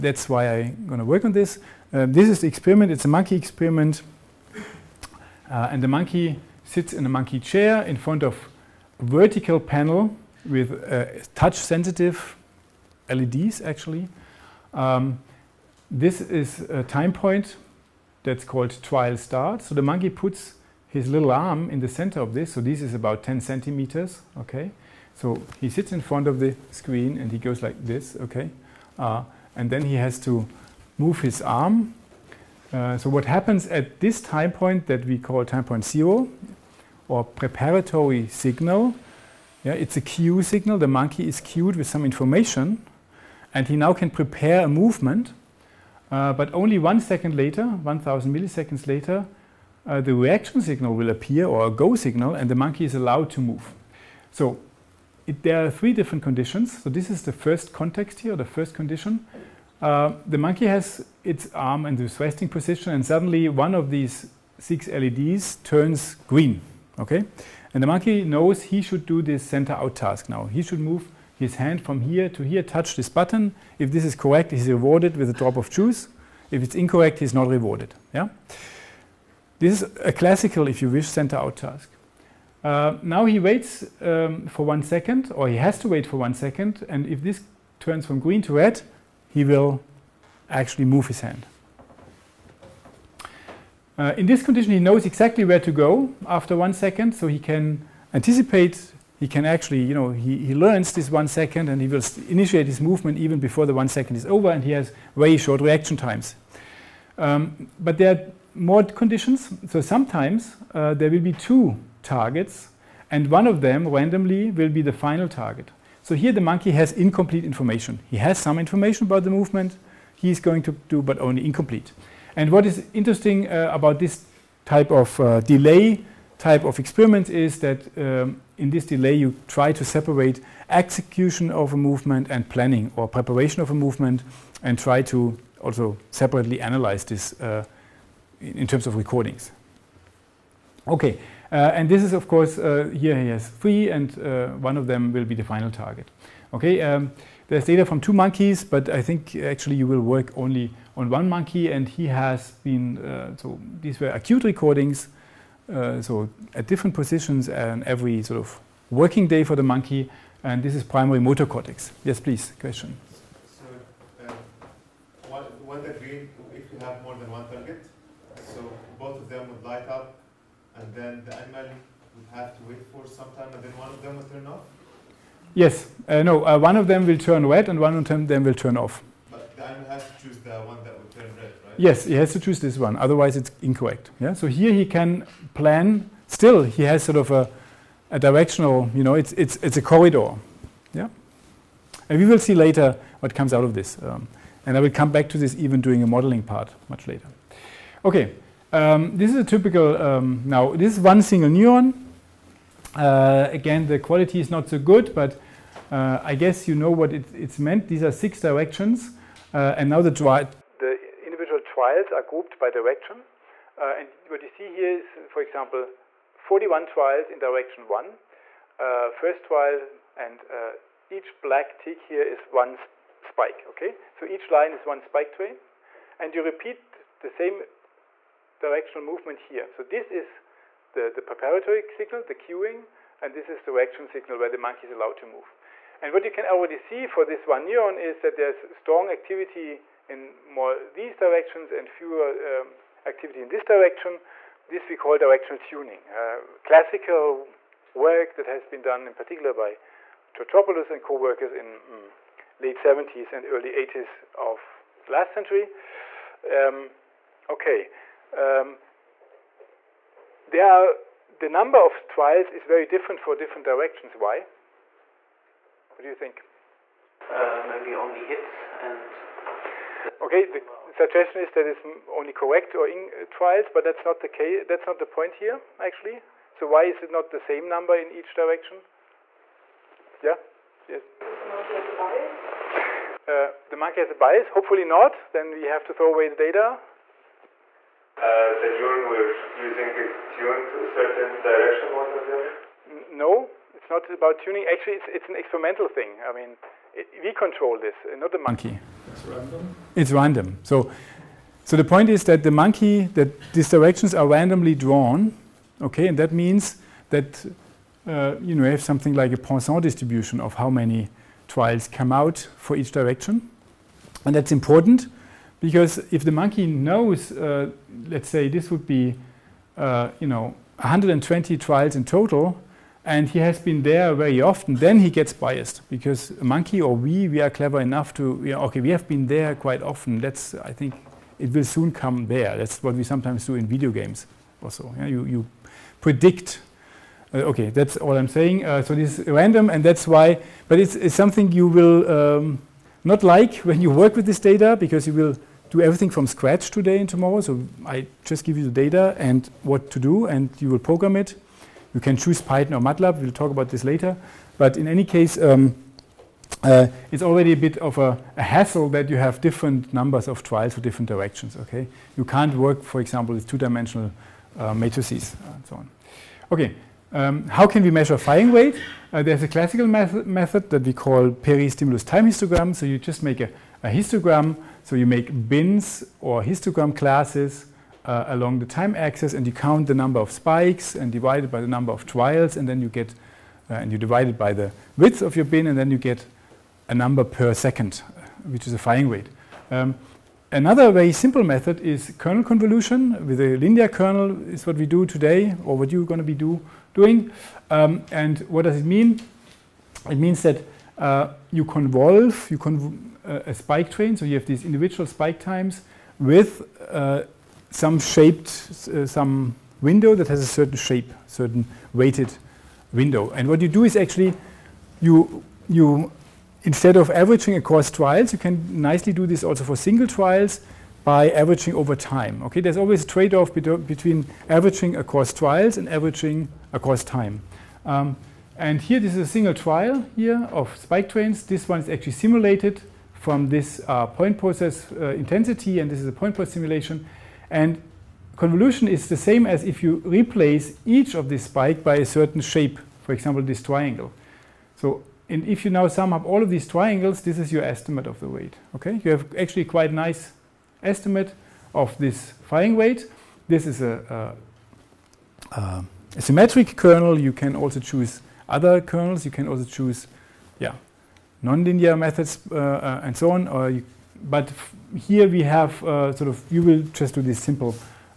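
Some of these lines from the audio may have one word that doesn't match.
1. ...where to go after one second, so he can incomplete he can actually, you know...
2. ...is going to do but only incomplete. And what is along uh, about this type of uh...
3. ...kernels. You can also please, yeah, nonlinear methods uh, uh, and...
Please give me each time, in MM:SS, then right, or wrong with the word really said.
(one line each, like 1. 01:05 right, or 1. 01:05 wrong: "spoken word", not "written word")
1. 01:35 wrong: "anticipate", not "incomplete"
2. 02:00 wrong: "interesting", not "along"
3. 07:38 wrong: "choose", not "please".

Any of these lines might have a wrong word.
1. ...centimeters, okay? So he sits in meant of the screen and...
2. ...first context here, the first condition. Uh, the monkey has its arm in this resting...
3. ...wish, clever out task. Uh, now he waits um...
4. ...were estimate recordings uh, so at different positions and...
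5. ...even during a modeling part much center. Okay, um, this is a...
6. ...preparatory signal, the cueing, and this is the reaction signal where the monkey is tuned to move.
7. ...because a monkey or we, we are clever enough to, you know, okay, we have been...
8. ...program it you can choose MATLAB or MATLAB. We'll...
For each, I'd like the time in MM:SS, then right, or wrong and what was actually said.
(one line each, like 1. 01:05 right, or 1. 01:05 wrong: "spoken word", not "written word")
1. 00:23 wrong: "front", not "meant"
2. 00:57 right
3. 01:20 wrong: "center", not "clever"
4. 02:33 wrong: "acute", not "estimate"
5. 03:15 wrong: "later", not "center"
6. 03:51 wrong: "allowed", not "tuned"
7. 05:25 right
8. 05:50 wrong: "Python", not "MATLAB".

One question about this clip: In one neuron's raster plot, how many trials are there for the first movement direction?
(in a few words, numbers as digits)
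41.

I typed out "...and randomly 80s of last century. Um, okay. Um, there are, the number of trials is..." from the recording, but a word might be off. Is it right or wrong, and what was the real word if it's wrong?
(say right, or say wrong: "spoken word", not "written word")
wrong: "early", not "randomly".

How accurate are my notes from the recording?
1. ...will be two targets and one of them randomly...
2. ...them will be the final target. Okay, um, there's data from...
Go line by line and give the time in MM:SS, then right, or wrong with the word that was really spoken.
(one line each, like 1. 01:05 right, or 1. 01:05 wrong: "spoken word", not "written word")
1. 01:51 right
2. 02:24 right.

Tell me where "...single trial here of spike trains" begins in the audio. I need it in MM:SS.
07:09.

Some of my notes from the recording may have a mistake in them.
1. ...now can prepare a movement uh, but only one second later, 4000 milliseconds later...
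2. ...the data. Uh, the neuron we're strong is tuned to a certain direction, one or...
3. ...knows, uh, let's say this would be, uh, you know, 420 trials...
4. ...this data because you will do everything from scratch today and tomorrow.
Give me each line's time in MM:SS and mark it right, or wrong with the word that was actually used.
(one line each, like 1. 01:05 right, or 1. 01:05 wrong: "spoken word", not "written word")
1. 00:43 wrong: "1000", not "4000"
2. 04:46 wrong: "using", not "strong"
3. 05:16 wrong: "120", not "420"
4. 05:44 right.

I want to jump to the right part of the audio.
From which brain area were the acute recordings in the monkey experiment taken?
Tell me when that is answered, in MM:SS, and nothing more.
02:40.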